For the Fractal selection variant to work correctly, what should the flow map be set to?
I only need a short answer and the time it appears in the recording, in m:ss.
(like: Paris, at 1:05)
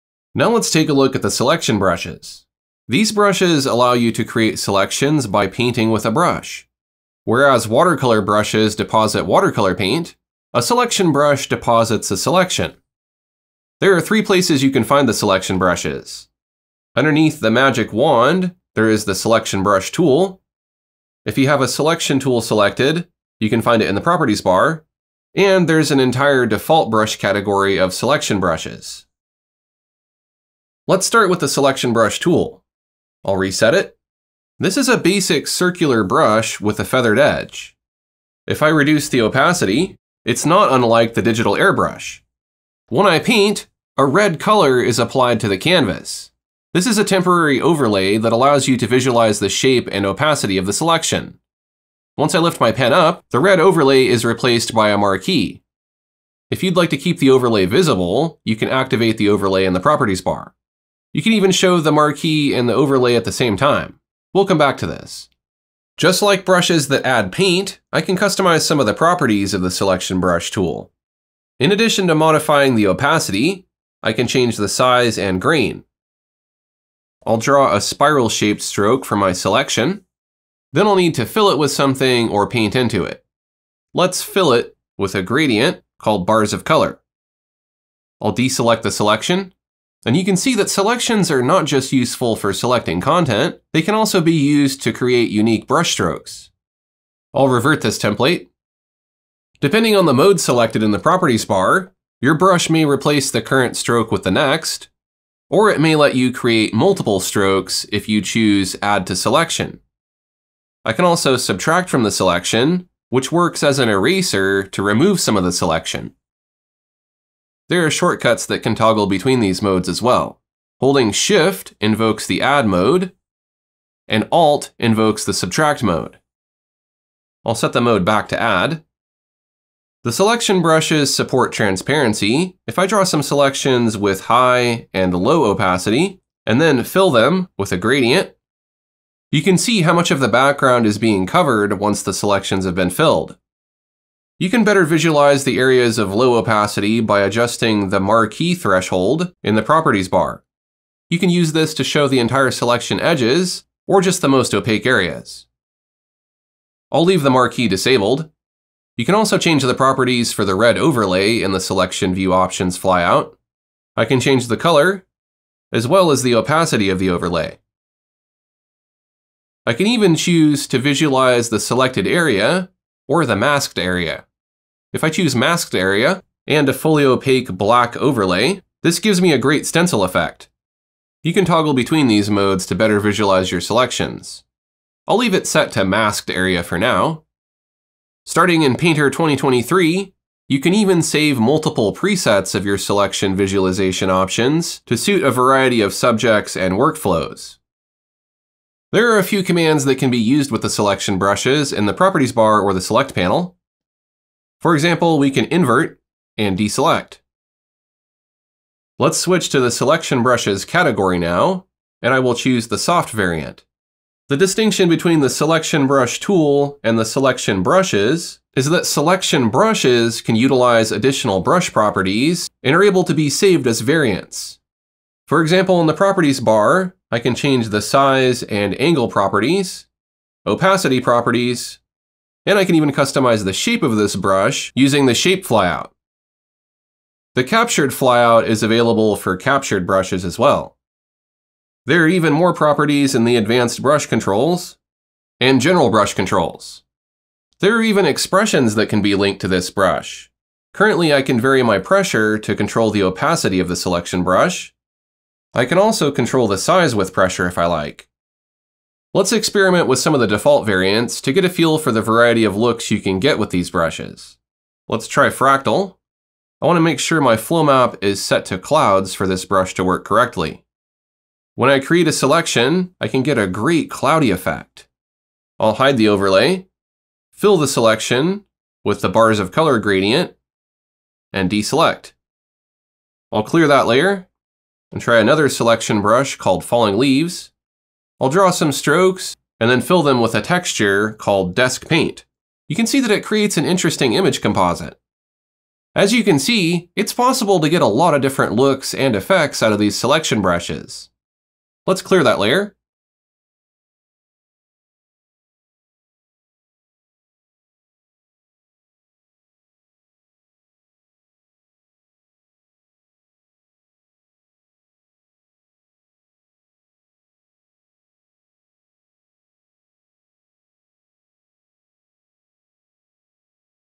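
Clouds, at 4:28.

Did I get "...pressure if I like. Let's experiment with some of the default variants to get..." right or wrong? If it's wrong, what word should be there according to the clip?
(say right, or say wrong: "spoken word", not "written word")
right.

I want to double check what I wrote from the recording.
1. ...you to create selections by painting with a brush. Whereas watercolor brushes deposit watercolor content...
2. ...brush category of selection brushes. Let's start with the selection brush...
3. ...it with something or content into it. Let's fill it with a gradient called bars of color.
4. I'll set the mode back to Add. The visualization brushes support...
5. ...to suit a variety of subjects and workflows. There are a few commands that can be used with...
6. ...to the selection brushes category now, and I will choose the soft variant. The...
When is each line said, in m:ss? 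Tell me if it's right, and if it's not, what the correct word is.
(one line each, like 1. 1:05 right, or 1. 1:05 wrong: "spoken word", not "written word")
1. 0:03 wrong: "paint", not "content"
2. 0:26 right
3. 1:21 wrong: "paint", not "content"
4. 2:07 wrong: "selection", not "visualization"
5. 3:14 right
6. 3:29 right.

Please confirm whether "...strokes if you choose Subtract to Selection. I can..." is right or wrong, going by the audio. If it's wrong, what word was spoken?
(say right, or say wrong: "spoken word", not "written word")
wrong: "Add", not "Subtract".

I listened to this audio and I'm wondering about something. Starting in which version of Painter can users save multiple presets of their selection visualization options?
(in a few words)
Painter 2023.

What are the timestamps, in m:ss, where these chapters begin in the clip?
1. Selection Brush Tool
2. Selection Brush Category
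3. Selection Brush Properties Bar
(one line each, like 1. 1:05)
1. 0:30
2. 3:28
3. 3:18.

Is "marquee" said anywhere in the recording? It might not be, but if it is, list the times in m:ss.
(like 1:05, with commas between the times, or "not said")
0:54, 1:01, 2:27, 2:37.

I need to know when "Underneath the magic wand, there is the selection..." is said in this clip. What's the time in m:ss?
0:16.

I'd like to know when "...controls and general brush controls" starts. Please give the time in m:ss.
4:04.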